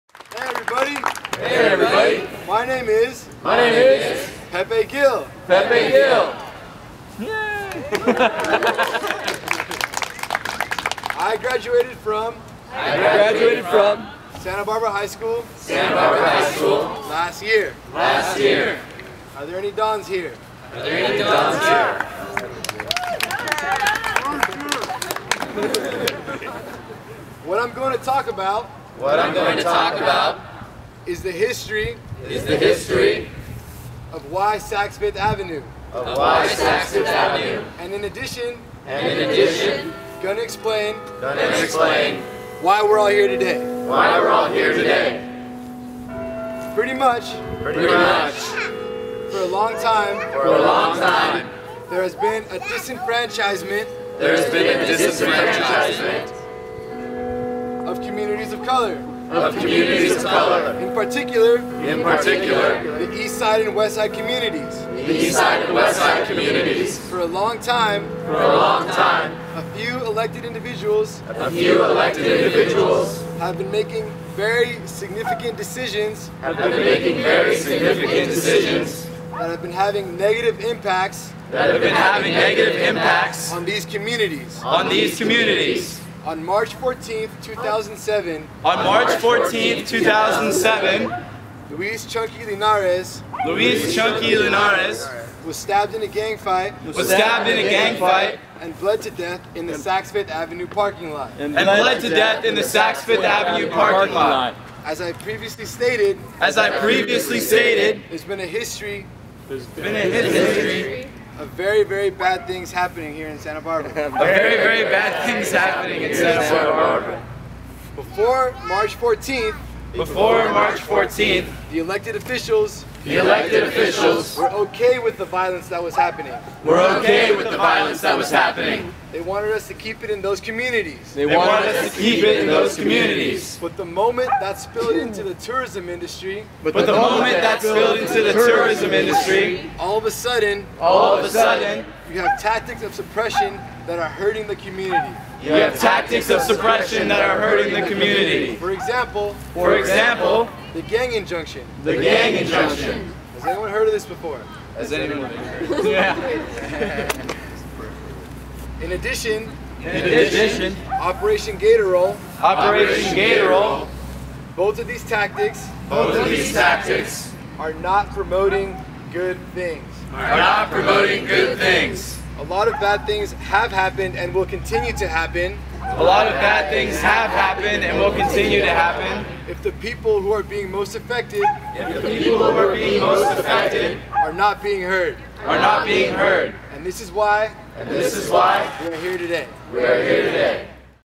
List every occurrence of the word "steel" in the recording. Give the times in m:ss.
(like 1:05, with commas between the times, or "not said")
not said.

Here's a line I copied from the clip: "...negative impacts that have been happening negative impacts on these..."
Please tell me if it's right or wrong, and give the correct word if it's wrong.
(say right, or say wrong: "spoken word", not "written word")
wrong: "having", not "happening".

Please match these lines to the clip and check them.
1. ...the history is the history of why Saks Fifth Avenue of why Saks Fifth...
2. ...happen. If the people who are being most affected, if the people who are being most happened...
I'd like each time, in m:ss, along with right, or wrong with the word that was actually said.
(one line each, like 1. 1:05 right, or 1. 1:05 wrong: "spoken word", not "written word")
1. 0:31 right
2. 2:58 wrong: "affected", not "happened".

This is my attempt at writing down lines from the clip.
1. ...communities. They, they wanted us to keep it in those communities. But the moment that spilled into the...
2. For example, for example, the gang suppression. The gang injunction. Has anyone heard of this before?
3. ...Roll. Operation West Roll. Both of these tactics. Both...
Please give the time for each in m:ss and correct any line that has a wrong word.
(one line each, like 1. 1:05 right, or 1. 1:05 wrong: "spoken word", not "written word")
1. 2:10 right
2. 2:28 wrong: "injunction", not "suppression"
3. 2:41 wrong: "Gator", not "West".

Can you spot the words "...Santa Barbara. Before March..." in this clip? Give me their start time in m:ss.
1:56.